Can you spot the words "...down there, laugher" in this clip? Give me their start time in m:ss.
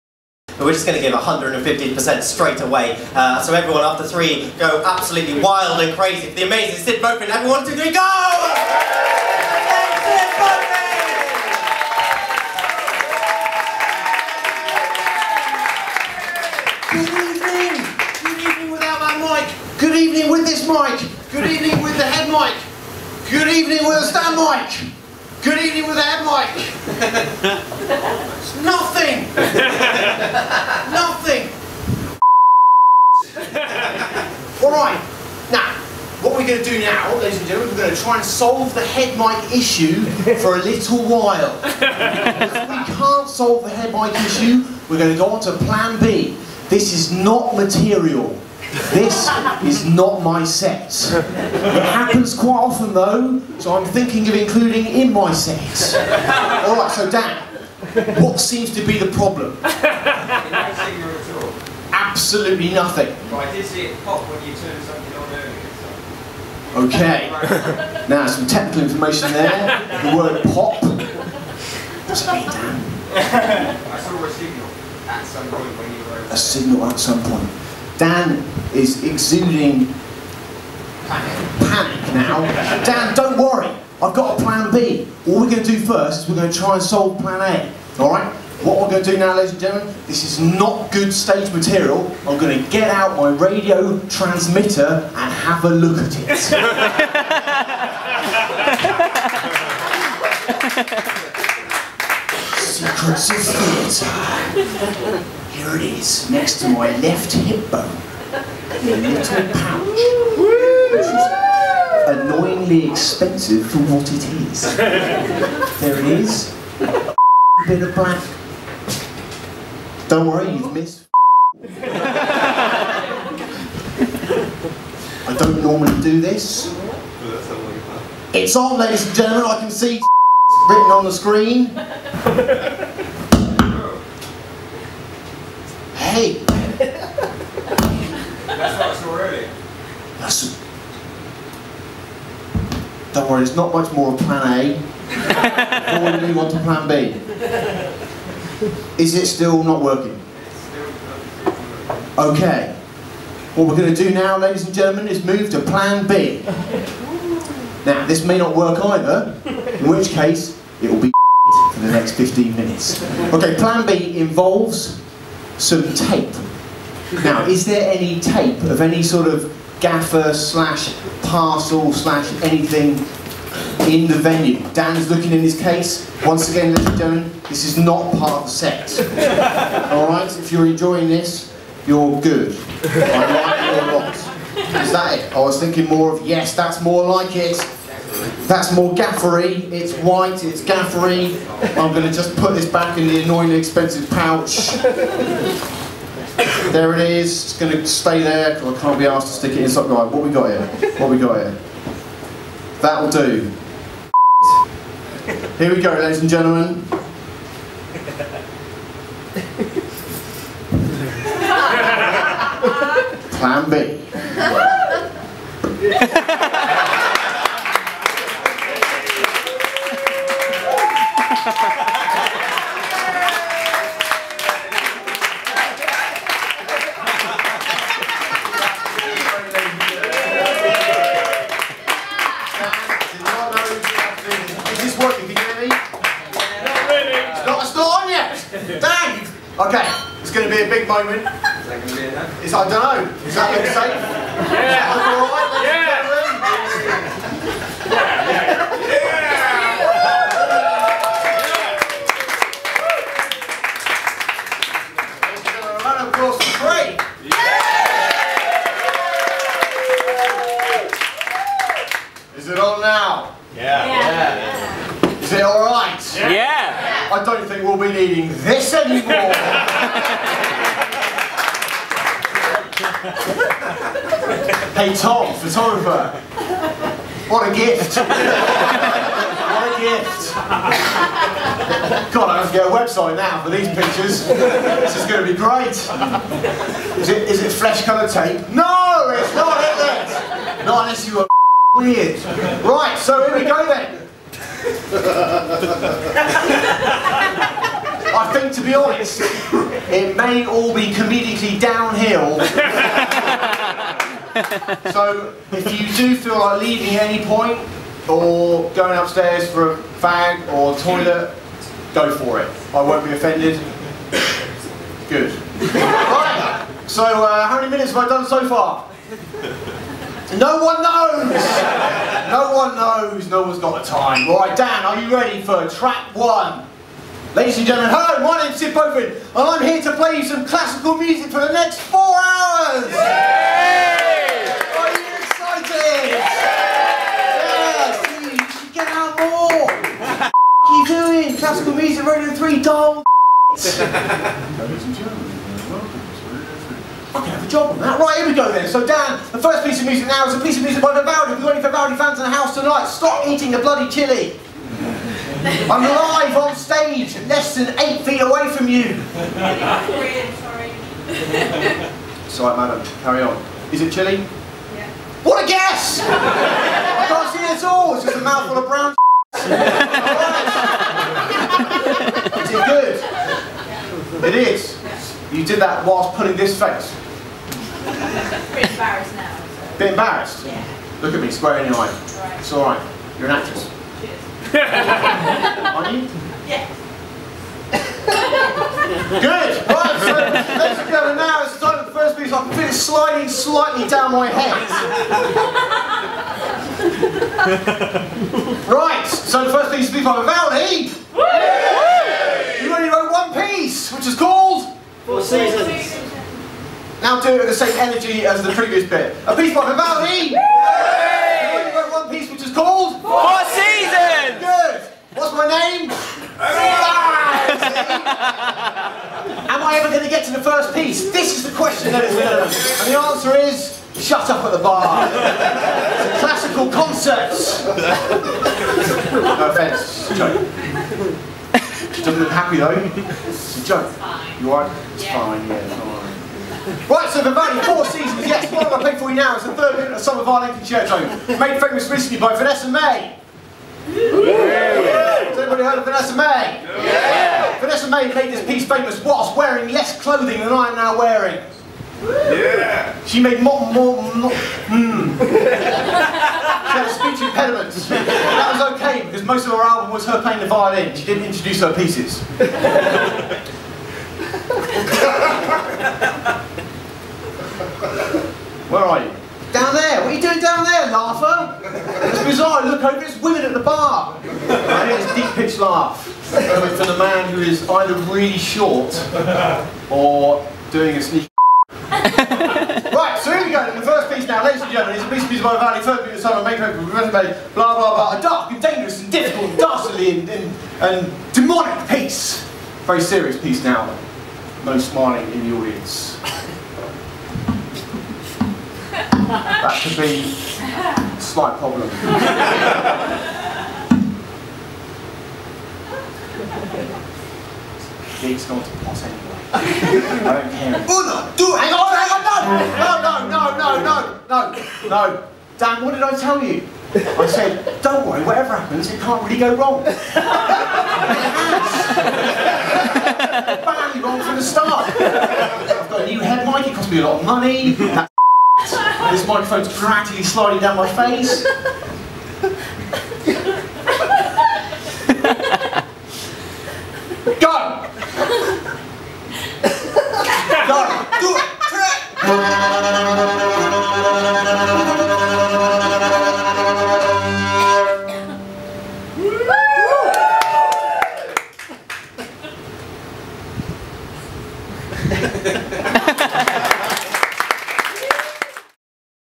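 7:50.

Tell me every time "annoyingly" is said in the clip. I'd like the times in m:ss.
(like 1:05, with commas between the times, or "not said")
1:52, 3:13.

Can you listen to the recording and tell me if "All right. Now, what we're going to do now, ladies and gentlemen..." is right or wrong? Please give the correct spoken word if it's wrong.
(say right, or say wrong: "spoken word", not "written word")
right.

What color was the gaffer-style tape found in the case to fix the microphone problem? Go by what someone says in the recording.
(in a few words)
White.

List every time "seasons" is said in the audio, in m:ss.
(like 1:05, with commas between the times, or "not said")
6:45, 7:17.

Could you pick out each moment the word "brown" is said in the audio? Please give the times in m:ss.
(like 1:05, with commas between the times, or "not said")
6:08.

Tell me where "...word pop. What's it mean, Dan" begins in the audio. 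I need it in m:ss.
1:10.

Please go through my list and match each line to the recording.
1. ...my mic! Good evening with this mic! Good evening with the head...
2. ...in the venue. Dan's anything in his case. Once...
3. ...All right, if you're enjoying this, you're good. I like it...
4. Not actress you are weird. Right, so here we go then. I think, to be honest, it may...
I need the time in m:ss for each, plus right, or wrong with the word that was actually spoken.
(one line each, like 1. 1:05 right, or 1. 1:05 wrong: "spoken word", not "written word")
1. 0:18 right
2. 2:53 wrong: "looking", not "anything"
3. 2:59 right
4. 4:50 wrong: "unless", not "actress".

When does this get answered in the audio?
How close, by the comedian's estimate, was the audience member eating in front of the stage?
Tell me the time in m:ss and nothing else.
5:57.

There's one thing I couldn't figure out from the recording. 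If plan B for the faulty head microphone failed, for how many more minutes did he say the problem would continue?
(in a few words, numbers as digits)
15.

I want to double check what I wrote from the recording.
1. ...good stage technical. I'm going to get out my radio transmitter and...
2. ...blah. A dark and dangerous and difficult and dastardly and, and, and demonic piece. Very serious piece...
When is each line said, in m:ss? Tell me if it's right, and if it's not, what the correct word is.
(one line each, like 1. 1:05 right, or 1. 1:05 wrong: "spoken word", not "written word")
1. 1:30 wrong: "material", not "technical"
2. 8:07 right.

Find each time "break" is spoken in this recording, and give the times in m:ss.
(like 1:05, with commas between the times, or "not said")
not said.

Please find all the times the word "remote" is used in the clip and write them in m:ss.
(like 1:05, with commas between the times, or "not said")
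not said.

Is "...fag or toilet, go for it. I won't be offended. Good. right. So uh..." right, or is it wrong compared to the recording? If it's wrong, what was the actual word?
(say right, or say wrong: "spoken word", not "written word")
right.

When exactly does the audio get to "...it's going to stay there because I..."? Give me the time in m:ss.
3:17.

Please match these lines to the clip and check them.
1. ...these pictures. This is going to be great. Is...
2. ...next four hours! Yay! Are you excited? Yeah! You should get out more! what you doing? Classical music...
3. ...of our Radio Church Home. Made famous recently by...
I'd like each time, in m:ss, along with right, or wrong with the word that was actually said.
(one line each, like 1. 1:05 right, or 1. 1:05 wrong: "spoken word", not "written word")
1. 4:43 right
2. 5:31 right
3. 7:20 wrong: "Lincoln", not "Radio".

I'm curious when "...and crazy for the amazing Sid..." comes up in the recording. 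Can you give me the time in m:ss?
0:05.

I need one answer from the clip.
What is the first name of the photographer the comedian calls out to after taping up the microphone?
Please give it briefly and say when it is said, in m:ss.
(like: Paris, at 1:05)
Tom, at 4:34.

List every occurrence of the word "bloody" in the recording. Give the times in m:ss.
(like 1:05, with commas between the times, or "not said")
5:53.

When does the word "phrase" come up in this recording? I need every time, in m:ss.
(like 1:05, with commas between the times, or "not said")
not said.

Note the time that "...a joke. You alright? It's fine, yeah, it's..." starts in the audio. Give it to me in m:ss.
7:13.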